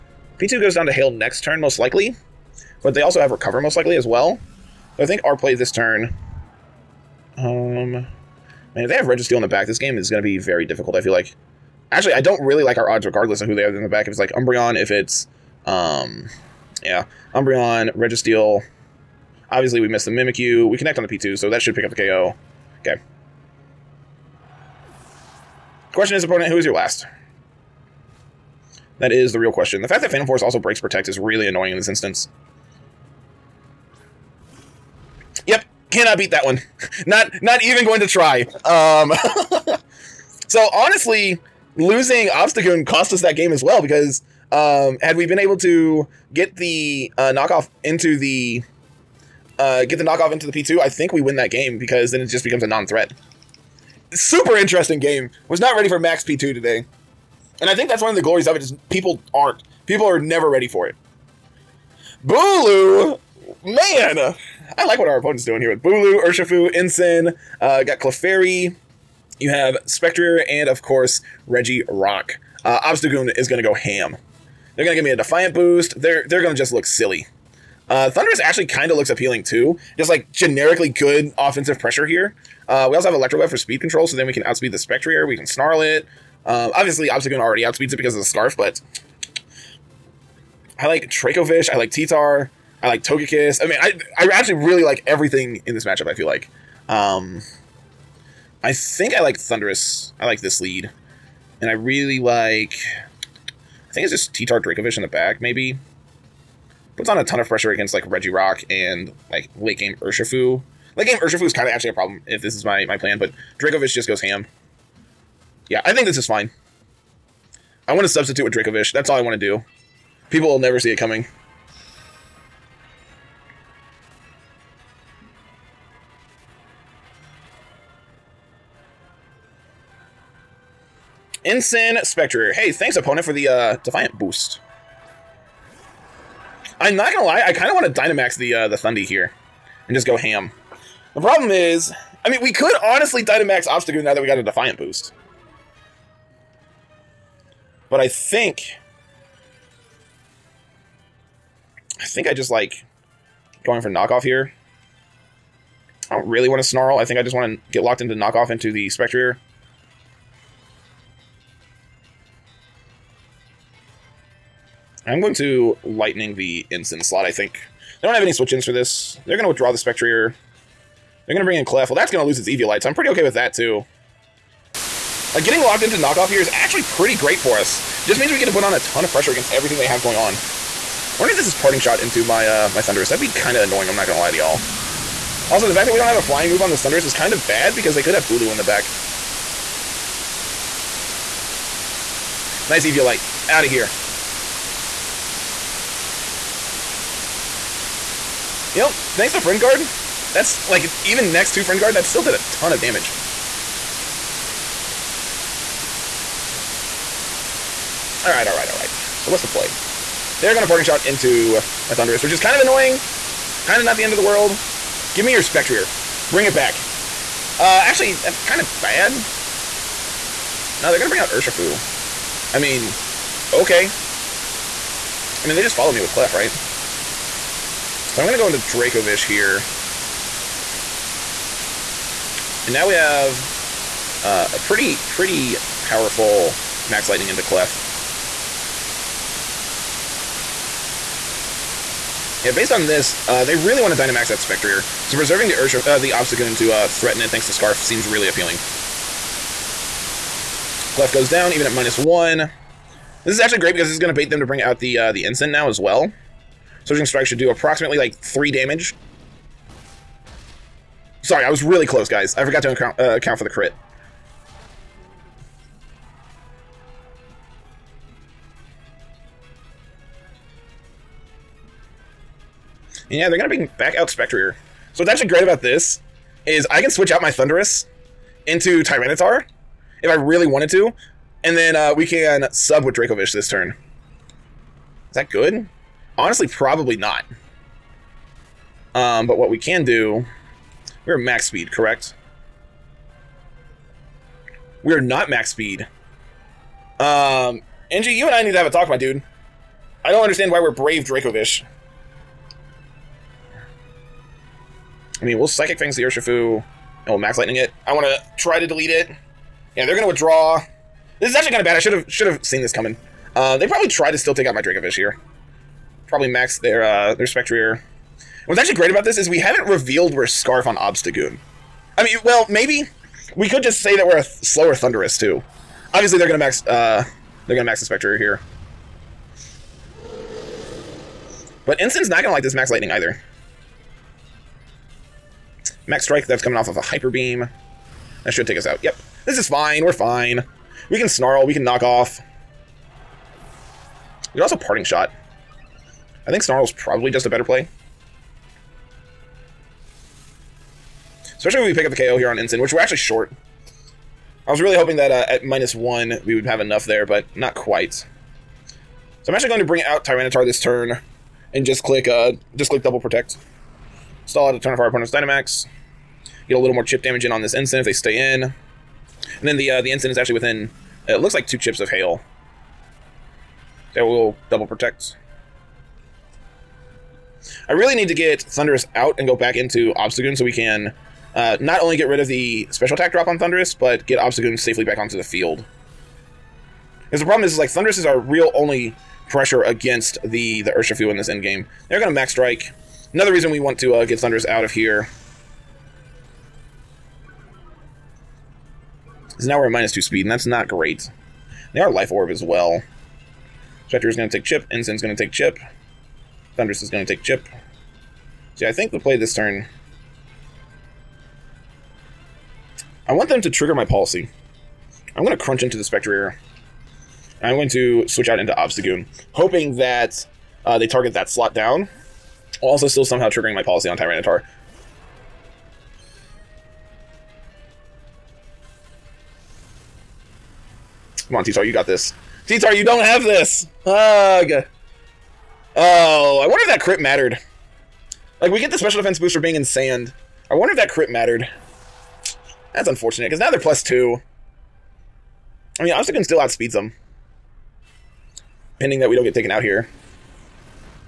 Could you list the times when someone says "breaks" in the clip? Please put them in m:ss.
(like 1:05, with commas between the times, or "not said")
0:30.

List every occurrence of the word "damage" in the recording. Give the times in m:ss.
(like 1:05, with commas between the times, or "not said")
3:22, 4:18, 6:07.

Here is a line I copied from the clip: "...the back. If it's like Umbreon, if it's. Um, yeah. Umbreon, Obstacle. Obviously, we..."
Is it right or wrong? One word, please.
wrong.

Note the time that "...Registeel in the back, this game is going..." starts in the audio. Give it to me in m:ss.
0:09.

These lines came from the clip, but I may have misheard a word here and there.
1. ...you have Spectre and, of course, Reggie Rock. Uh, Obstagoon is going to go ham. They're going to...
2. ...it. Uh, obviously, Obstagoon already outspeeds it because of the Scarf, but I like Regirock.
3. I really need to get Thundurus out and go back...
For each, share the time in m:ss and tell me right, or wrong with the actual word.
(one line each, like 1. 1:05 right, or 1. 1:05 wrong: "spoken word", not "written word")
1. 1:09 right
2. 1:25 wrong: "Dracovish", not "Regirock"
3. 6:17 right.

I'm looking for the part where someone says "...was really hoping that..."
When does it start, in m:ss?
5:54.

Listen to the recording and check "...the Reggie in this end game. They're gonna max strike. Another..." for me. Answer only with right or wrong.
wrong.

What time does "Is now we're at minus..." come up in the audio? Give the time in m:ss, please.
6:39.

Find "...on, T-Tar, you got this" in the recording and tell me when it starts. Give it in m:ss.
7:11.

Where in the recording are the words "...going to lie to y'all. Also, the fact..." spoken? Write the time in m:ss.
3:04.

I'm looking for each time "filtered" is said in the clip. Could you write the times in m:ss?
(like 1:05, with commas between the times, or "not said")
not said.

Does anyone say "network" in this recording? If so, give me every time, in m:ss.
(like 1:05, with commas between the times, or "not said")
not said.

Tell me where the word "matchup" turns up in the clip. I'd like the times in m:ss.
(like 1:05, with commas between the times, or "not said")
1:35.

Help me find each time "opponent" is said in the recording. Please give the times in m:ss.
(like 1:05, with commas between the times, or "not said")
0:26, 1:05, 2:12, 6:04.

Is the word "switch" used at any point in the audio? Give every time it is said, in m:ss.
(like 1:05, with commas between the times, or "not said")
2:48, 4:36, 6:58.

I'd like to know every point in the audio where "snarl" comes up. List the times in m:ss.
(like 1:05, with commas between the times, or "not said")
1:25, 2:36, 5:41, 5:46.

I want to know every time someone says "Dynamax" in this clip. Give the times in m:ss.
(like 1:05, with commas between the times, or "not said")
2:17, 2:23, 4:03, 6:05.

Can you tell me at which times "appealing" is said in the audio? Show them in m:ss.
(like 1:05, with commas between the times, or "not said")
1:19, 4:08.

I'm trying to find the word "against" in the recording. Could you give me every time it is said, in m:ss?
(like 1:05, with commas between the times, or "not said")
1:47, 2:59, 6:29.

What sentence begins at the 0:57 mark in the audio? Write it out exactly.
And I think that's one of the glories of it is people aren't.